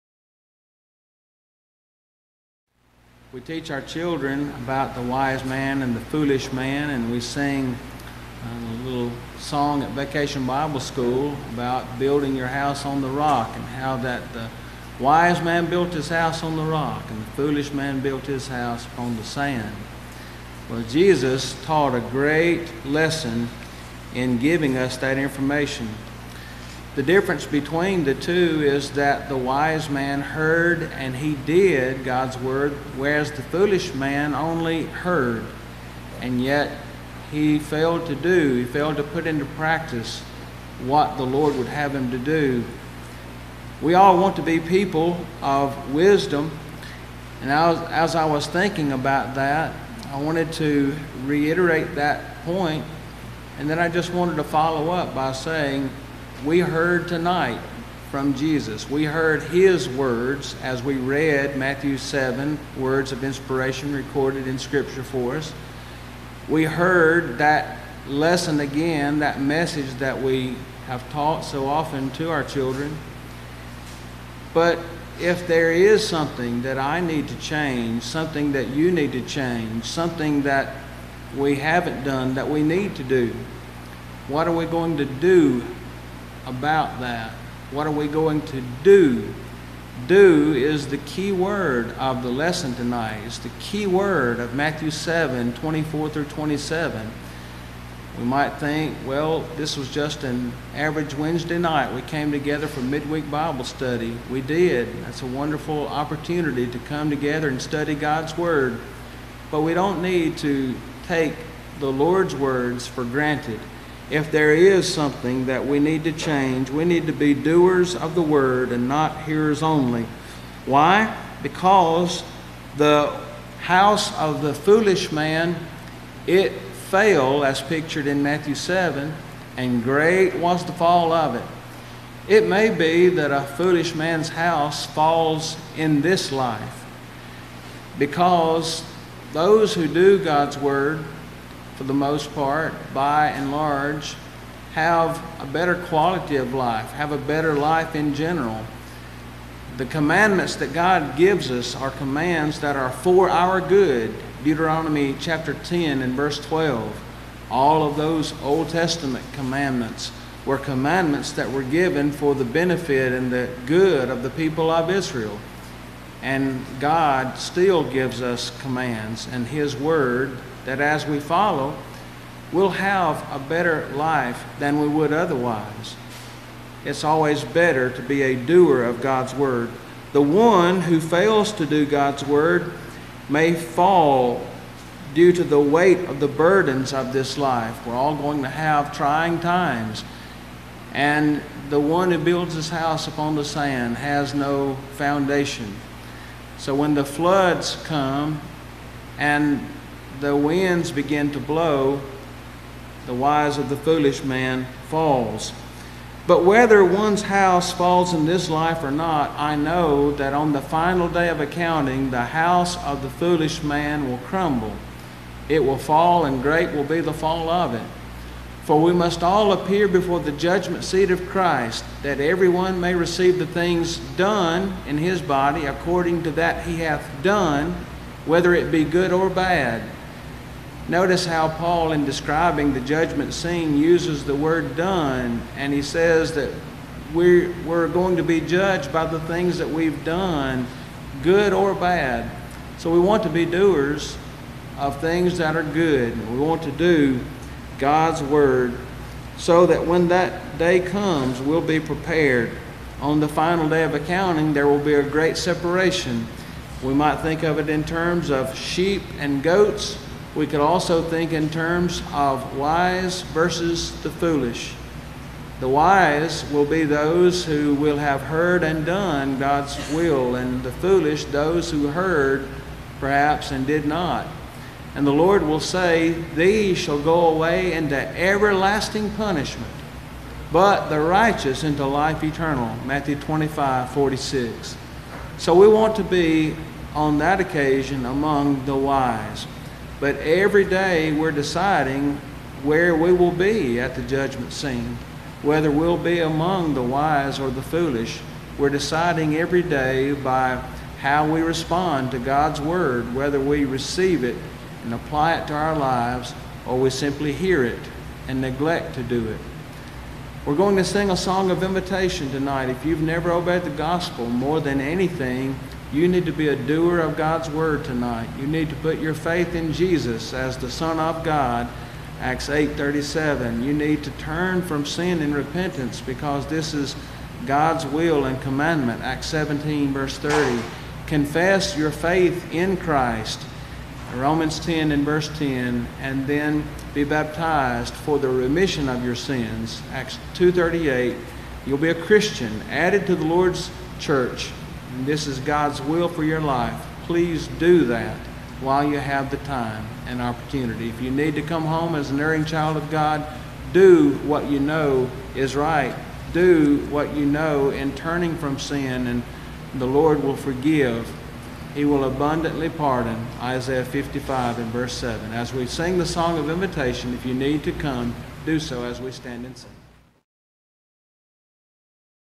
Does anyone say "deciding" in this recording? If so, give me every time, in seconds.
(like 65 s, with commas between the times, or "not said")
291 s, 298 s.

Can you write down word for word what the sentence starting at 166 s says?
And God still gives us commands, and His Word that as we follow, we'll have a better life than we would otherwise.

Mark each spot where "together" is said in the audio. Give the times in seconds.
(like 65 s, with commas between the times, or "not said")
102 s, 107 s.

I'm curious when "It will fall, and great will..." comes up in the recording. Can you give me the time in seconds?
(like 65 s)
215 s.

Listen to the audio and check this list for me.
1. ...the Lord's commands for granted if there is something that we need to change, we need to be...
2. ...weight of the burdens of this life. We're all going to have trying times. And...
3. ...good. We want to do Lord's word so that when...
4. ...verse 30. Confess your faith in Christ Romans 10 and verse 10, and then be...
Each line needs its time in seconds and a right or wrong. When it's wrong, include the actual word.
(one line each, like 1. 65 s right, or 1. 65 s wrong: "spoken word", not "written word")
1. 111 s wrong: "words", not "commands"
2. 185 s right
3. 245 s wrong: "God", not "Lord"
4. 329 s right.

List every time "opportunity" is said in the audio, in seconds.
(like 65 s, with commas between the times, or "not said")
105 s, 350 s.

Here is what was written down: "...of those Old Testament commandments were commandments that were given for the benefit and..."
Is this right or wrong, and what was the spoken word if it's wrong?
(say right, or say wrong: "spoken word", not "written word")
right.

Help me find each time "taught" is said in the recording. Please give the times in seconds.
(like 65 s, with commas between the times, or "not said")
21 s, 71 s.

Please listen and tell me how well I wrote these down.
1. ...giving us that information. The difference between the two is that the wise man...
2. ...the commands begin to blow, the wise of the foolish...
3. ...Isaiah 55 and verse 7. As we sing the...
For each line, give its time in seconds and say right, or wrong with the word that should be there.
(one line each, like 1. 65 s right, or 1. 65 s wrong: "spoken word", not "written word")
1. 24 s right
2. 200 s wrong: "winds", not "commands"
3. 363 s right.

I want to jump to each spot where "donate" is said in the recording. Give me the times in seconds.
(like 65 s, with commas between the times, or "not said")
not said.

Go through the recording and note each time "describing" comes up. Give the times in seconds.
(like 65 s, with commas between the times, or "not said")
232 s.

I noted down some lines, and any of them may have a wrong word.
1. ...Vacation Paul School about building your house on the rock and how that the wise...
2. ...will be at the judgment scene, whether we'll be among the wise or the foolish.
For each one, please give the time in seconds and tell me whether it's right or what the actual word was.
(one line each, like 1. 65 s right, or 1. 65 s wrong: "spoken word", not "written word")
1. 9 s wrong: "Bible", not "Paul"
2. 293 s right.